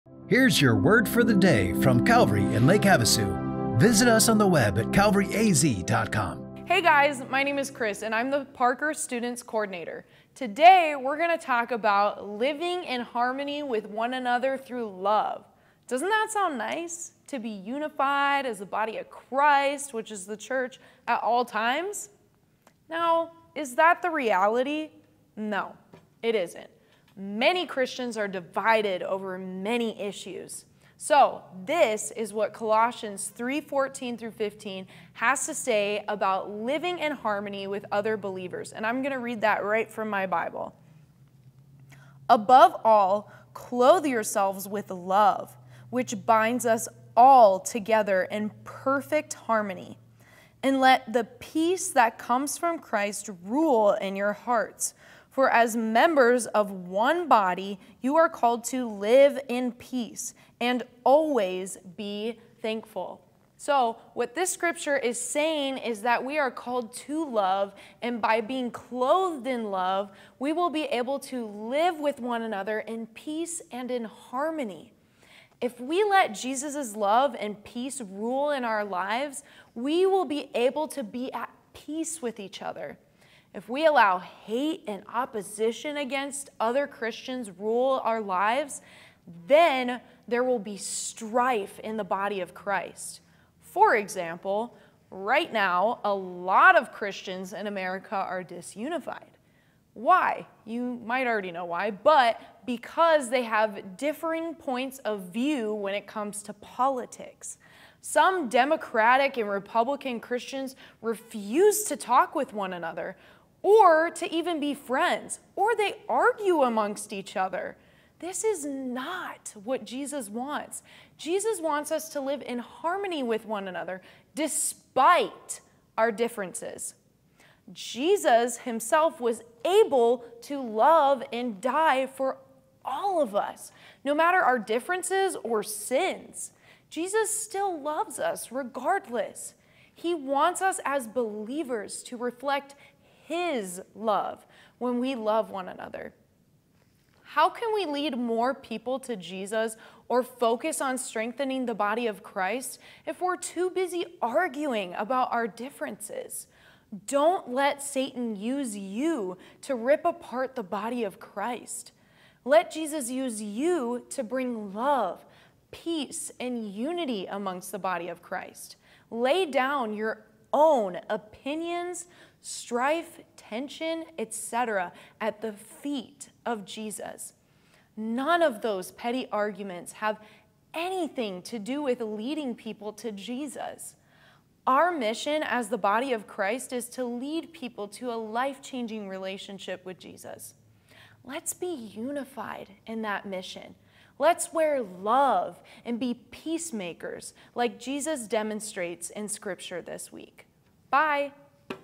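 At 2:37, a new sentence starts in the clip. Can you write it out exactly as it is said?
Don't let Satan use you to rip apart the body of Christ.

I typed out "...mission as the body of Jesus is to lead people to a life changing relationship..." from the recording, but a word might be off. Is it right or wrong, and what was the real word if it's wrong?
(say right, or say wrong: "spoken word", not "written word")
wrong: "Christ", not "Jesus".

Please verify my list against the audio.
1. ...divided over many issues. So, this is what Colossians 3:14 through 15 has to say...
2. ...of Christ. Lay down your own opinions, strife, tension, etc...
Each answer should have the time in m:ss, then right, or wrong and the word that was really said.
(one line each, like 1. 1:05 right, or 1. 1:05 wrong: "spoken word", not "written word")
1. 0:28 right
2. 2:48 right.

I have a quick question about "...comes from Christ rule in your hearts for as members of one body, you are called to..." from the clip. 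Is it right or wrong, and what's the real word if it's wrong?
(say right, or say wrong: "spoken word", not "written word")
right.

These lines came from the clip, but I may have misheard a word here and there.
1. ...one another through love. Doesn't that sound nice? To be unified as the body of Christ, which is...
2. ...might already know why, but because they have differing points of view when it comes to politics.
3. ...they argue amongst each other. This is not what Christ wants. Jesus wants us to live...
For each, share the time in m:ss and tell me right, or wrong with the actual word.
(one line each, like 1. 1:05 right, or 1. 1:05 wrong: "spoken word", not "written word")
1. 0:13 right
2. 1:41 right
3. 1:55 wrong: "Jesus", not "Christ".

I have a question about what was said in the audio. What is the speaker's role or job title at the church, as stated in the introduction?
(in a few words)
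Parker Students Coordinator.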